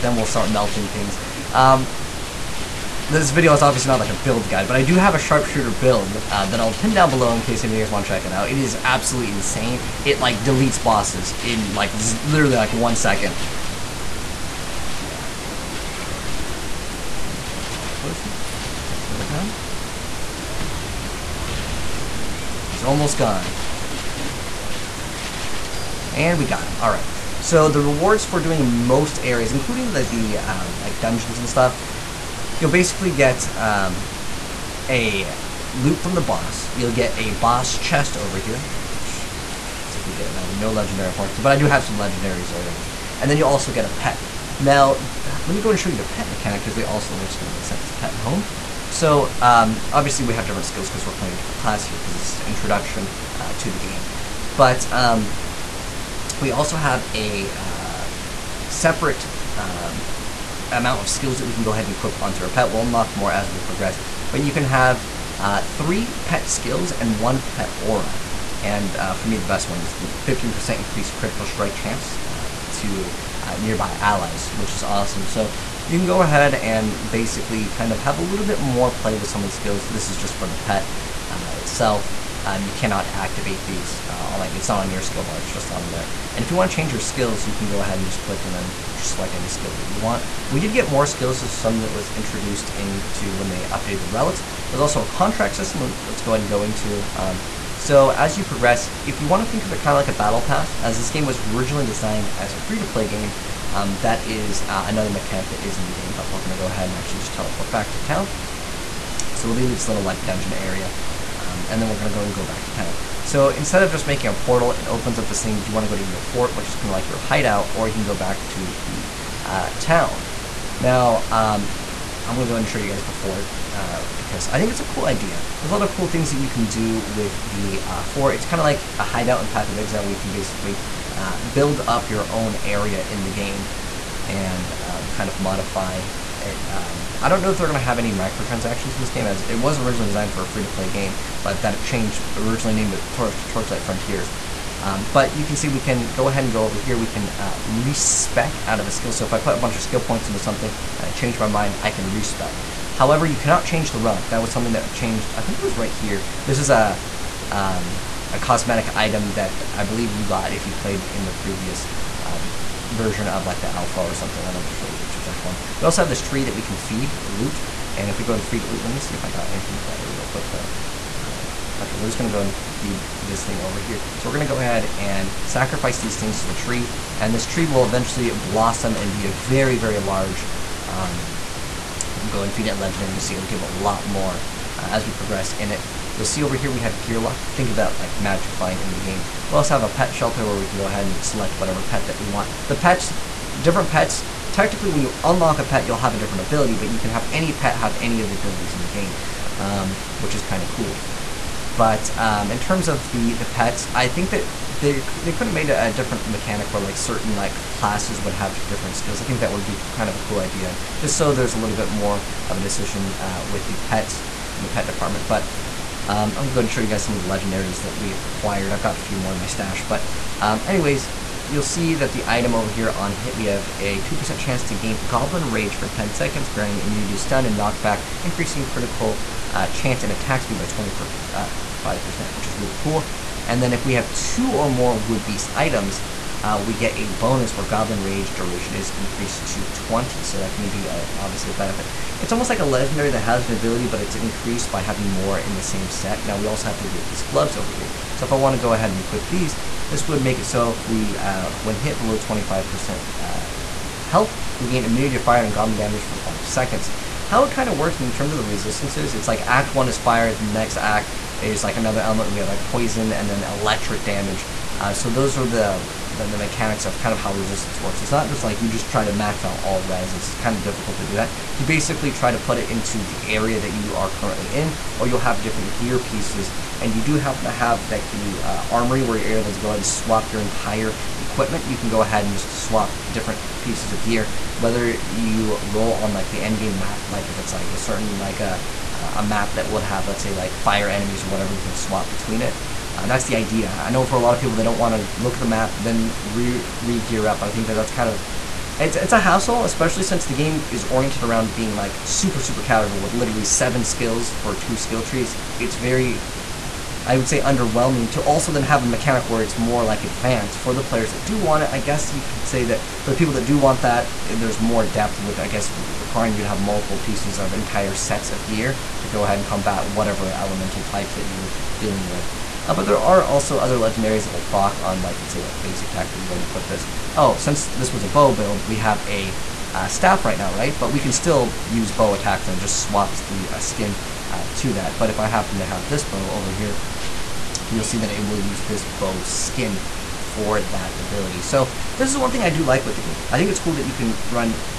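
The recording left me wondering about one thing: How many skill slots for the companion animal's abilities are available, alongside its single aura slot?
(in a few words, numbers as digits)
3.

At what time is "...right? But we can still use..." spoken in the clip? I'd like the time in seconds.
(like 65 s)
330 s.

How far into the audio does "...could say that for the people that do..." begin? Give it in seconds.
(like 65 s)
312 s.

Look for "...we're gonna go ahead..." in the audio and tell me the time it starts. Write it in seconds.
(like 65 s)
174 s.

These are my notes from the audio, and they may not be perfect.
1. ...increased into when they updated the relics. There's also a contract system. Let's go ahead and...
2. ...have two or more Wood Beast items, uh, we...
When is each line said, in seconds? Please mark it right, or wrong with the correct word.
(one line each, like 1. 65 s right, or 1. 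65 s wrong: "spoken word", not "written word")
1. 92 s wrong: "introduced", not "increased"
2. 233 s right.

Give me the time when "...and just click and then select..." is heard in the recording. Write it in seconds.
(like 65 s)
87 s.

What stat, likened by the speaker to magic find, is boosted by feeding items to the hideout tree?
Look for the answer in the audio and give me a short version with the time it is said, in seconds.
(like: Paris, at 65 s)
Gear luck, at 186 s.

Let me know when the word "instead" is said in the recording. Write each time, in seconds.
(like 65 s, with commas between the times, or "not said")
113 s.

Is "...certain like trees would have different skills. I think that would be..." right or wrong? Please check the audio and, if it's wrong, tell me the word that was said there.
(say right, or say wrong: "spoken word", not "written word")
wrong: "classes", not "trees".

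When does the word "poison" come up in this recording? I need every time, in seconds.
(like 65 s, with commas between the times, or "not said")
262 s.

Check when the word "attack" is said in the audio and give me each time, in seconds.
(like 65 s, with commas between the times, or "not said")
230 s, 325 s, 332 s.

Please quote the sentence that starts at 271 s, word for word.
You basically try to put it into the area that you are currently in, or you'll have different gear pieces.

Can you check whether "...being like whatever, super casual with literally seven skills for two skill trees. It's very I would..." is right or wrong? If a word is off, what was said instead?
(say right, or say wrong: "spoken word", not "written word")
wrong: "super", not "whatever".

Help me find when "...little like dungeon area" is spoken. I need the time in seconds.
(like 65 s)
109 s.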